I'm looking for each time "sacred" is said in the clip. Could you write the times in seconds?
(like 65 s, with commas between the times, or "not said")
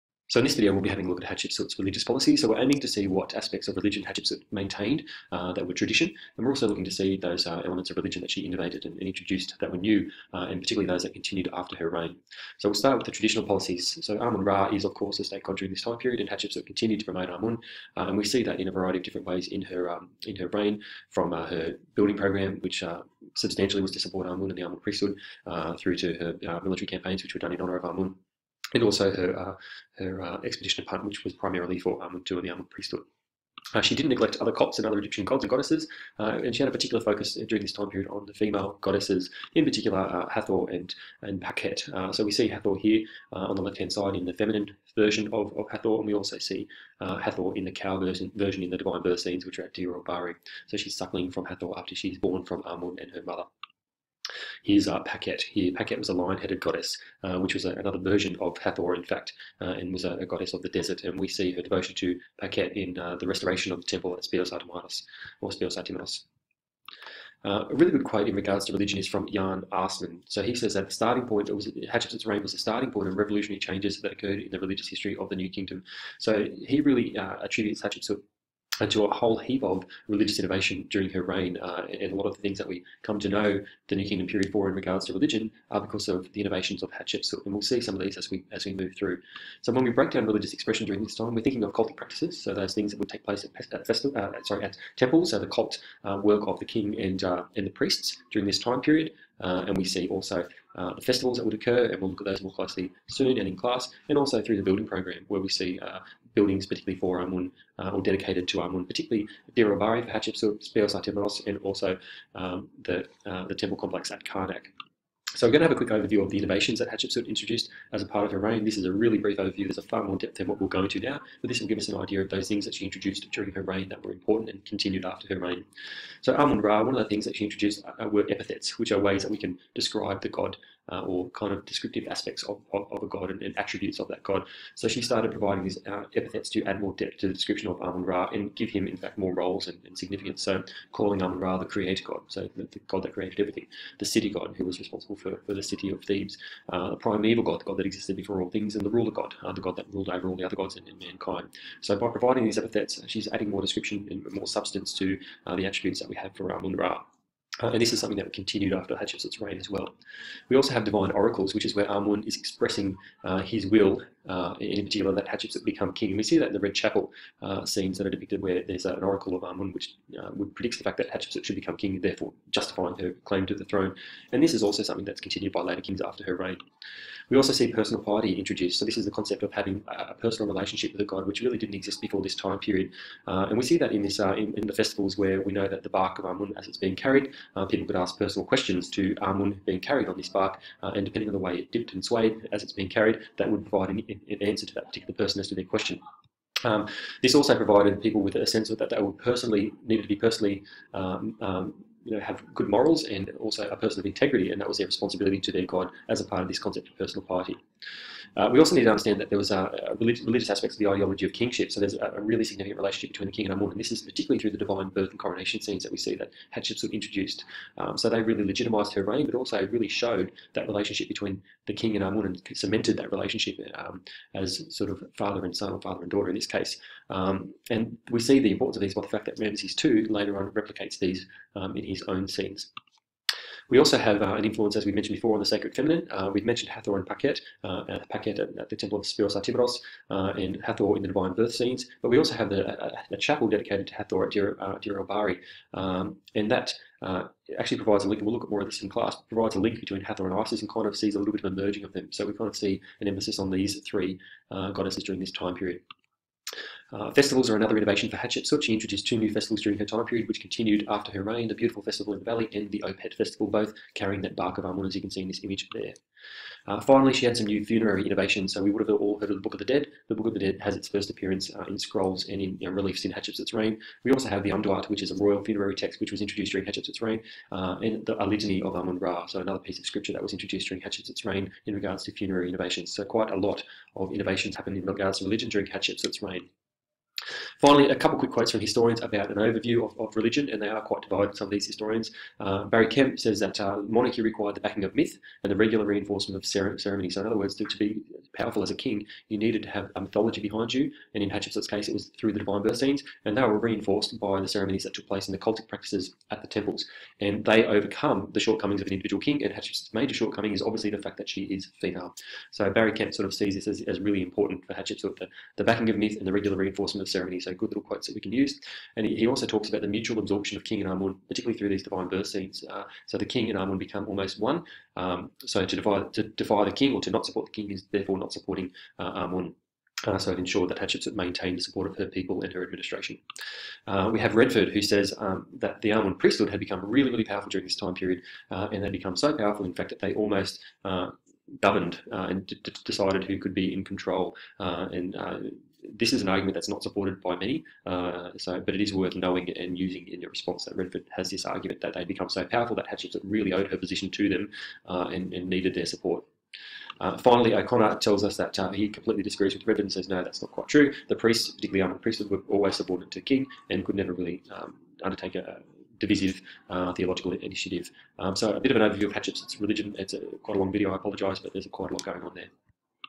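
235 s.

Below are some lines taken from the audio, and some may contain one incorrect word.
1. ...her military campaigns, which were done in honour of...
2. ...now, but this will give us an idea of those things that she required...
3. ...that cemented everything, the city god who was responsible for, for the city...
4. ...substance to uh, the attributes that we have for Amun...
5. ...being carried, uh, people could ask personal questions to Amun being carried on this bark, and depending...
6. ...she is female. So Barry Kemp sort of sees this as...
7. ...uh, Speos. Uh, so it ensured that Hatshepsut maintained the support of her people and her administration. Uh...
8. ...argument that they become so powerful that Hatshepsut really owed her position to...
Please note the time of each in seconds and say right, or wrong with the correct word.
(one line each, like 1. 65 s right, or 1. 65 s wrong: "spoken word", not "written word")
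1. 26 s right
2. 120 s wrong: "introduced", not "required"
3. 143 s wrong: "created", not "cemented"
4. 154 s right
5. 186 s right
6. 311 s right
7. 328 s wrong: "Amun", not "Speos"
8. 351 s right.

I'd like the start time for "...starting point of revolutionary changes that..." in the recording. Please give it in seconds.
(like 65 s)
72 s.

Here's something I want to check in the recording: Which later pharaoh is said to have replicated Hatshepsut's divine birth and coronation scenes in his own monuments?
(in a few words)
Ramses II.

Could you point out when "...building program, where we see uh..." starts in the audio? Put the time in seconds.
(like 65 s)
104 s.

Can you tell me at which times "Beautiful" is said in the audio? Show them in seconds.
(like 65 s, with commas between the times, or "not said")
261 s.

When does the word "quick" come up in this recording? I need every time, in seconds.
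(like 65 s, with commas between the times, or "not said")
115 s, 288 s.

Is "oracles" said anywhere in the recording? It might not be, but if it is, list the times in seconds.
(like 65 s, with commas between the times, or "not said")
161 s, 169 s.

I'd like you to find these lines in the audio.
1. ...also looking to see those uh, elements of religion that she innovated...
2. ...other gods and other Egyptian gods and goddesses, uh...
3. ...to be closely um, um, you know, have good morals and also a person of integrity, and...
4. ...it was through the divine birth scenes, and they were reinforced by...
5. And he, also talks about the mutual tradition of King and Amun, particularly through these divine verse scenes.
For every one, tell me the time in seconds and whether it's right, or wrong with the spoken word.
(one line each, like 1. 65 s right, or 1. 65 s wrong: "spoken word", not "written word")
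1. 6 s right
2. 34 s right
3. 200 s wrong: "personally", not "closely"
4. 301 s right
5. 318 s wrong: "absorption", not "tradition".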